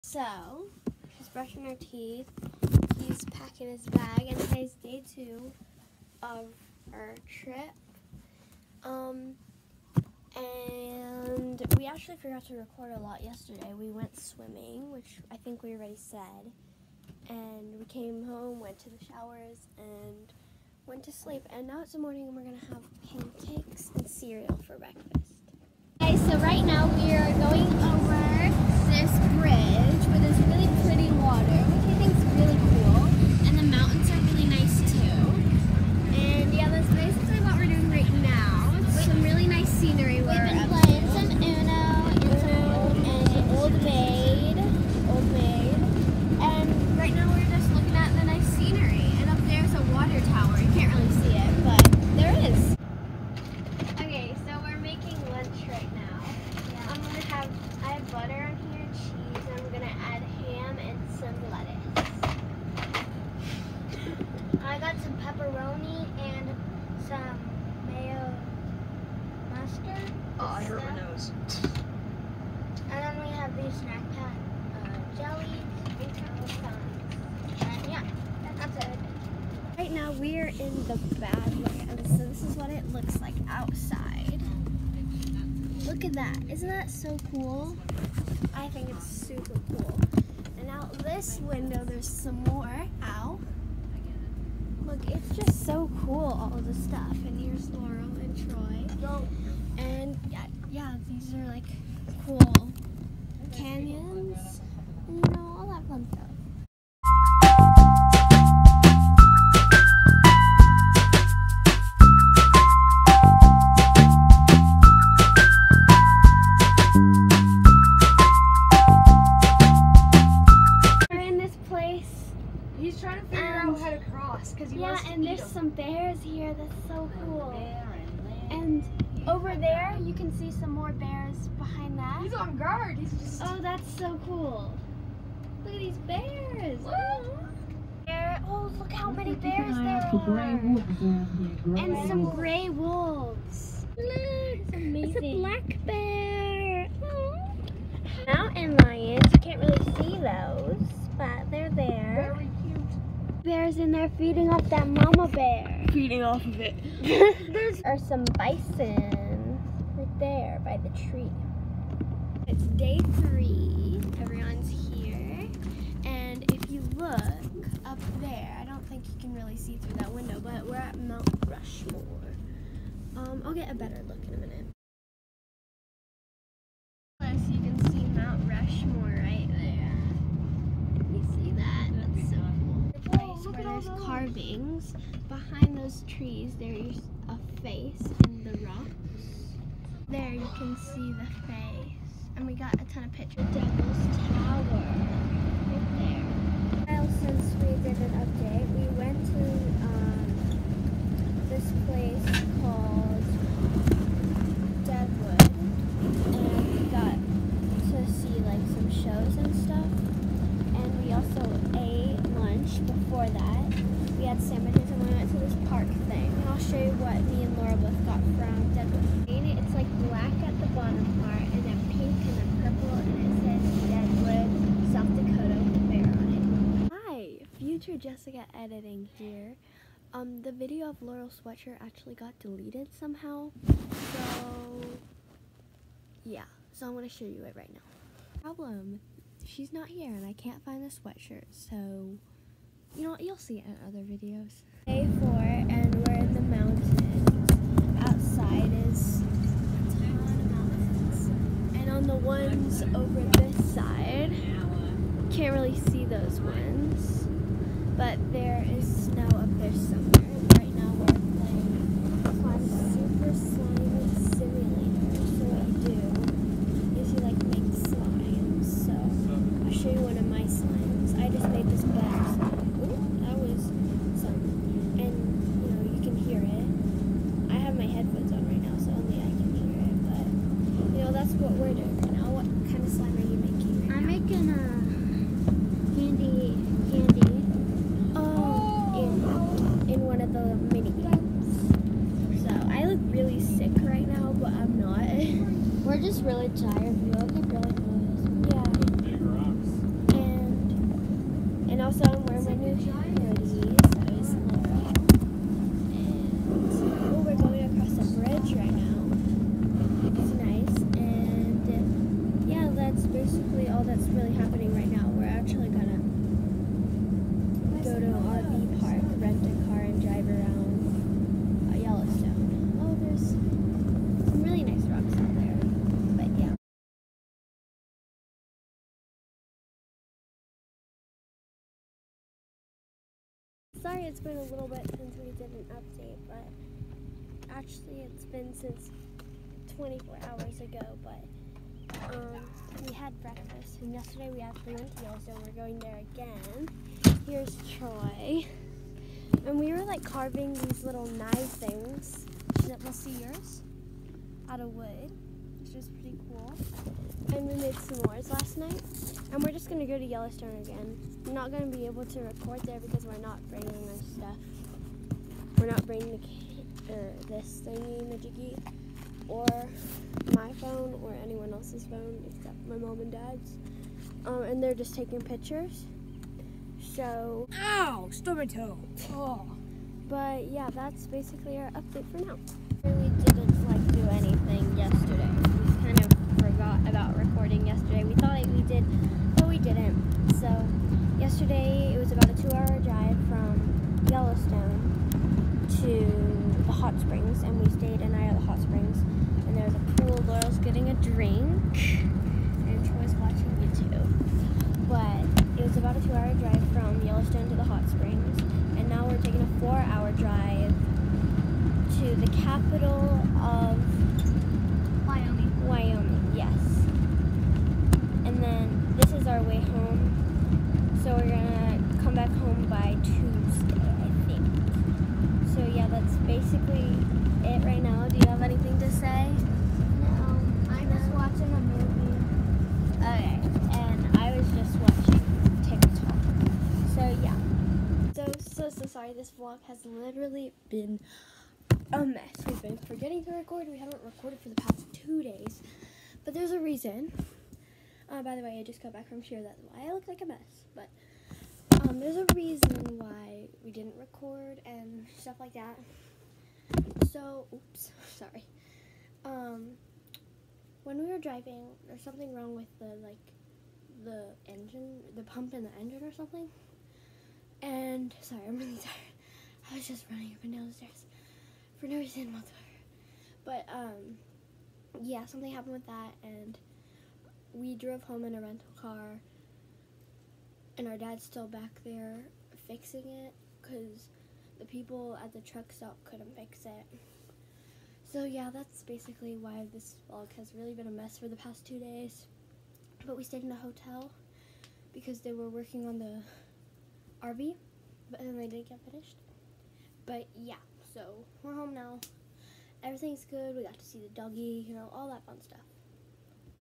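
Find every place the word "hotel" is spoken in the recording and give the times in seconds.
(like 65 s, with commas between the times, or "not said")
493 s.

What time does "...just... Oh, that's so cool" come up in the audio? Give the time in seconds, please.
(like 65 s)
133 s.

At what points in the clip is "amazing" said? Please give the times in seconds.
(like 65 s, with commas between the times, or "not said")
144 s.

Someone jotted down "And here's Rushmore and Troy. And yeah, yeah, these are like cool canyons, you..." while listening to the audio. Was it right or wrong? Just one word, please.
wrong.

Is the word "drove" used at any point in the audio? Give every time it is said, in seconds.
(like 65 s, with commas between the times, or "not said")
477 s.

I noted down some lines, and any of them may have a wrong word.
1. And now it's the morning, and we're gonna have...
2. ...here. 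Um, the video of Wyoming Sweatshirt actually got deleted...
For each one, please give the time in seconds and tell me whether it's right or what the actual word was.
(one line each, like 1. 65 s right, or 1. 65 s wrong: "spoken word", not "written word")
1. 21 s right
2. 229 s wrong: "Laurel", not "Wyoming".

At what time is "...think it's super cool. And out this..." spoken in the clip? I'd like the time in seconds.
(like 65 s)
88 s.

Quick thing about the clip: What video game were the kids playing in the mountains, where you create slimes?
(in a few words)
Super Slime Simulator.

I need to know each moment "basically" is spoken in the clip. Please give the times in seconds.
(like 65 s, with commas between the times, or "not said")
381 s, 426 s, 488 s.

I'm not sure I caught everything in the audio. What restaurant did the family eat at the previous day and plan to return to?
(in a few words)
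Valentino's.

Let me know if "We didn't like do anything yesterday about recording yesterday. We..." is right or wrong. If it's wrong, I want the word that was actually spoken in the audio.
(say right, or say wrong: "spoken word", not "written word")
right.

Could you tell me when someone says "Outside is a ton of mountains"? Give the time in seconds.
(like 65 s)
248 s.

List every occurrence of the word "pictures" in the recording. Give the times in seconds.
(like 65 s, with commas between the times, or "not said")
193 s, 375 s.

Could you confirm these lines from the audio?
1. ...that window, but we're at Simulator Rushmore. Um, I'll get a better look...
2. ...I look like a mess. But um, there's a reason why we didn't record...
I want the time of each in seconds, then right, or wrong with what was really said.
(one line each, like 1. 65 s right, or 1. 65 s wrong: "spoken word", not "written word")
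1. 169 s wrong: "Mount", not "Simulator"
2. 449 s right.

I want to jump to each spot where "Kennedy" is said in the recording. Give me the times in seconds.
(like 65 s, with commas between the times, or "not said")
not said.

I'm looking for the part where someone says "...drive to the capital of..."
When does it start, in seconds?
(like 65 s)
410 s.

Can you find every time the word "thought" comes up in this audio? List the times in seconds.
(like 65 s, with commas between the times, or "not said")
388 s.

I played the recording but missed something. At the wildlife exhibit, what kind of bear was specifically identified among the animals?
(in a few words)
black bear.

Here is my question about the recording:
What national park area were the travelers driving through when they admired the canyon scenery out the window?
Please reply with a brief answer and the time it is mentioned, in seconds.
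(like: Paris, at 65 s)
the Badlands, at 81 s.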